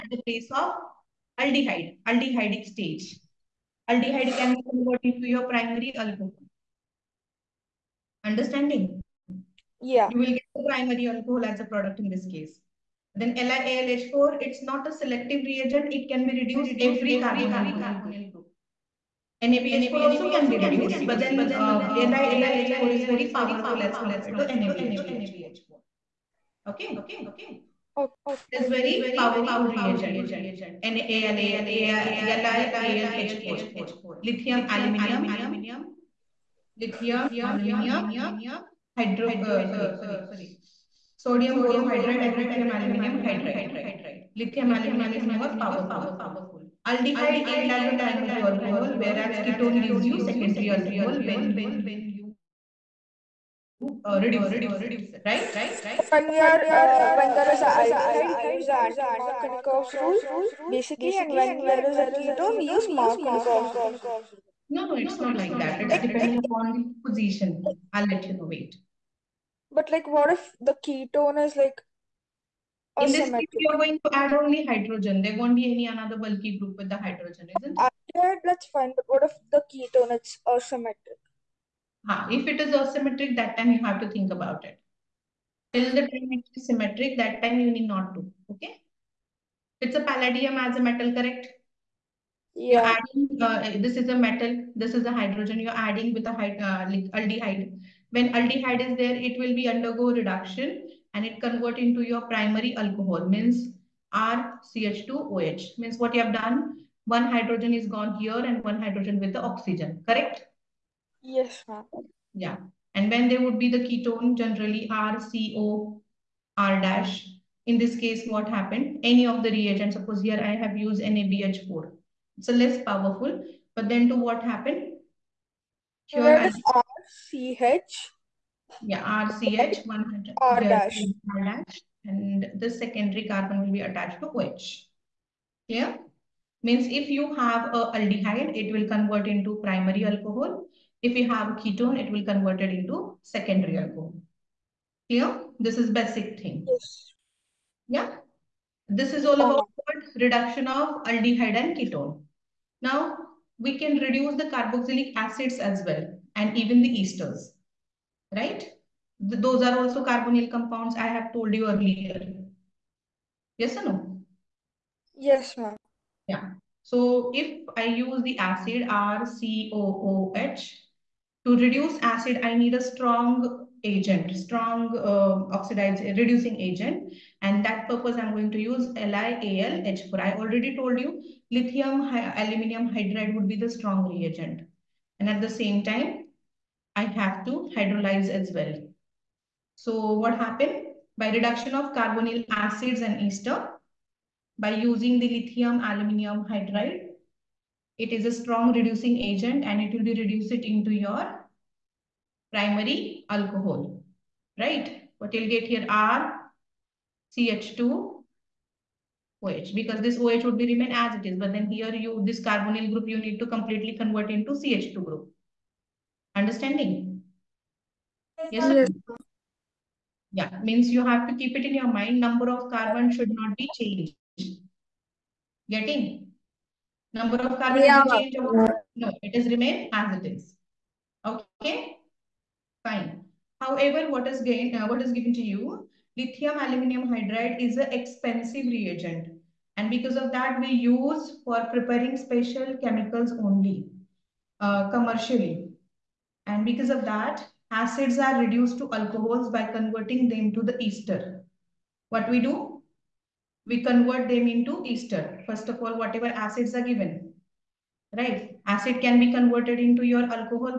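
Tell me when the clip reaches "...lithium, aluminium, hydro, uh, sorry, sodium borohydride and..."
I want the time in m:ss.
0:36.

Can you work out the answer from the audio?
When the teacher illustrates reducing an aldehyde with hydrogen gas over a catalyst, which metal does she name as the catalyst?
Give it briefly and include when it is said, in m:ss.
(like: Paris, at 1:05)
Palladium, at 1:30.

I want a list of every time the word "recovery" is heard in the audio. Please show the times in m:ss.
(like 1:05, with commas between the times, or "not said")
not said.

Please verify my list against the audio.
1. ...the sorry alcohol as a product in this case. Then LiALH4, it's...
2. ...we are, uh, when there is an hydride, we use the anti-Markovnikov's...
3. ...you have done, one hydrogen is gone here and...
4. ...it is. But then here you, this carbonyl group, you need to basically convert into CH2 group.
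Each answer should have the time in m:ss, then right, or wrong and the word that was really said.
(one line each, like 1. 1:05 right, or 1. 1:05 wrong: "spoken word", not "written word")
1. 0:10 wrong: "primary", not "sorry"
2. 0:56 wrong: "aldehyde", not "hydride"
3. 1:46 right
4. 3:31 wrong: "completely", not "basically".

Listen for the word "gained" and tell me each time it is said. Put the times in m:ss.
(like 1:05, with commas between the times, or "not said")
3:54.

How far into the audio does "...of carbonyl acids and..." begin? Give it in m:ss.
3:11.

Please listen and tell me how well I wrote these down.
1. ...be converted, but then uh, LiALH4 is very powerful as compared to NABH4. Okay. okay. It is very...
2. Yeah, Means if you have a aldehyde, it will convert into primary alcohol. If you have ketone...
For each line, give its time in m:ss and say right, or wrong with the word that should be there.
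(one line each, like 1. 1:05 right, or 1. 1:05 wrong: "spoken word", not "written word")
1. 0:20 wrong: "reduced", not "converted"
2. 2:15 right.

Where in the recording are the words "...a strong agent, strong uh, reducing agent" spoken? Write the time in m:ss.
2:52.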